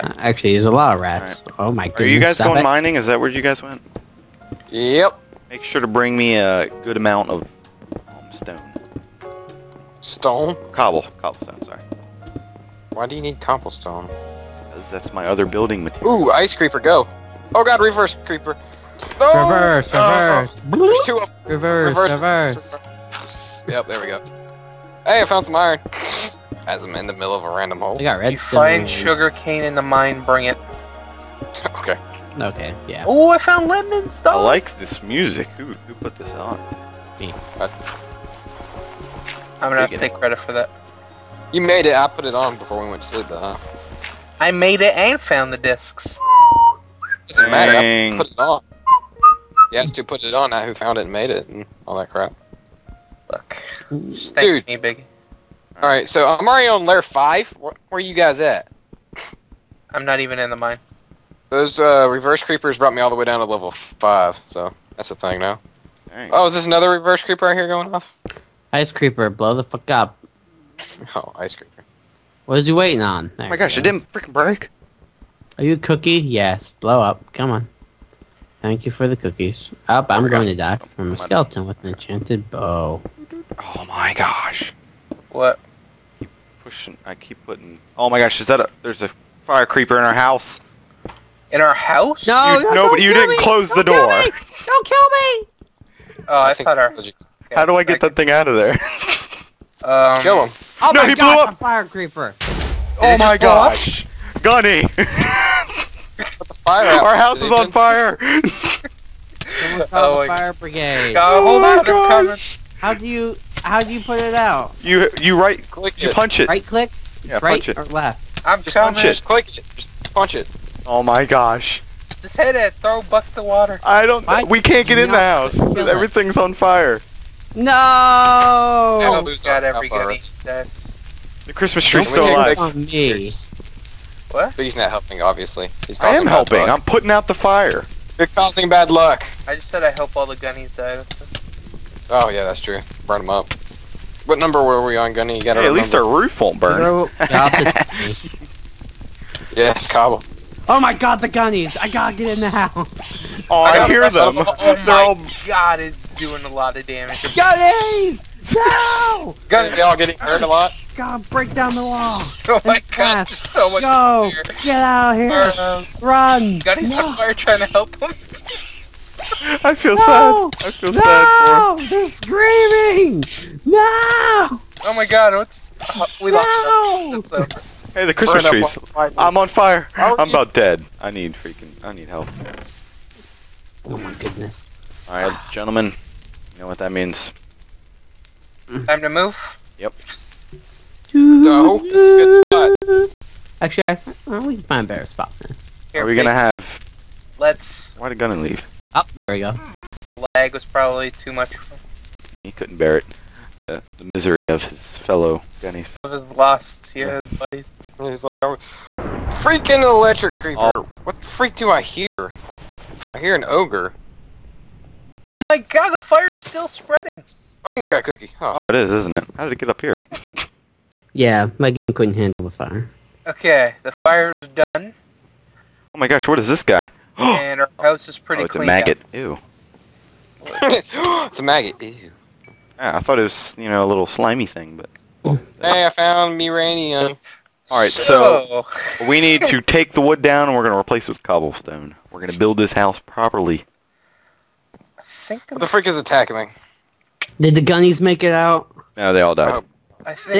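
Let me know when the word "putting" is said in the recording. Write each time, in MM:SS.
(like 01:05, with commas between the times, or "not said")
01:27, 02:16.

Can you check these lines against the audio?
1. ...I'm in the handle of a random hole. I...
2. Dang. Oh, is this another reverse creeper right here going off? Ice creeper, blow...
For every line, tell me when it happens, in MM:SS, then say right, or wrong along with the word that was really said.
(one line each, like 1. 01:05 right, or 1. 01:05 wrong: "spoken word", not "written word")
1. 00:26 wrong: "middle", not "handle"
2. 01:06 right.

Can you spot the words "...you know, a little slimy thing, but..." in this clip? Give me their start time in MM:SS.
03:53.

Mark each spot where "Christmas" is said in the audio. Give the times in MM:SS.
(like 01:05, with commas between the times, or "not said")
02:11, 02:58.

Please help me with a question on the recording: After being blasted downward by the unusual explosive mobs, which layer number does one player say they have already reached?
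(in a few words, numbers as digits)
5.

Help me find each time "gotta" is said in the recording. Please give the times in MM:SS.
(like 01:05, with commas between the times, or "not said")
02:25, 02:31.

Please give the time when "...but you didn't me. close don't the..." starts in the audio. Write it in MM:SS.
01:32.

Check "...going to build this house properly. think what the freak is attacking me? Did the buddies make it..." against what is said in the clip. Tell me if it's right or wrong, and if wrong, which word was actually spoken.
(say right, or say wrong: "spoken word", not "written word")
wrong: "gunnies", not "buddies".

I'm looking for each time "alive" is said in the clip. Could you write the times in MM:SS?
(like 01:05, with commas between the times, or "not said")
02:12.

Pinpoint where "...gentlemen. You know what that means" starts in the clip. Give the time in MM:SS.
03:05.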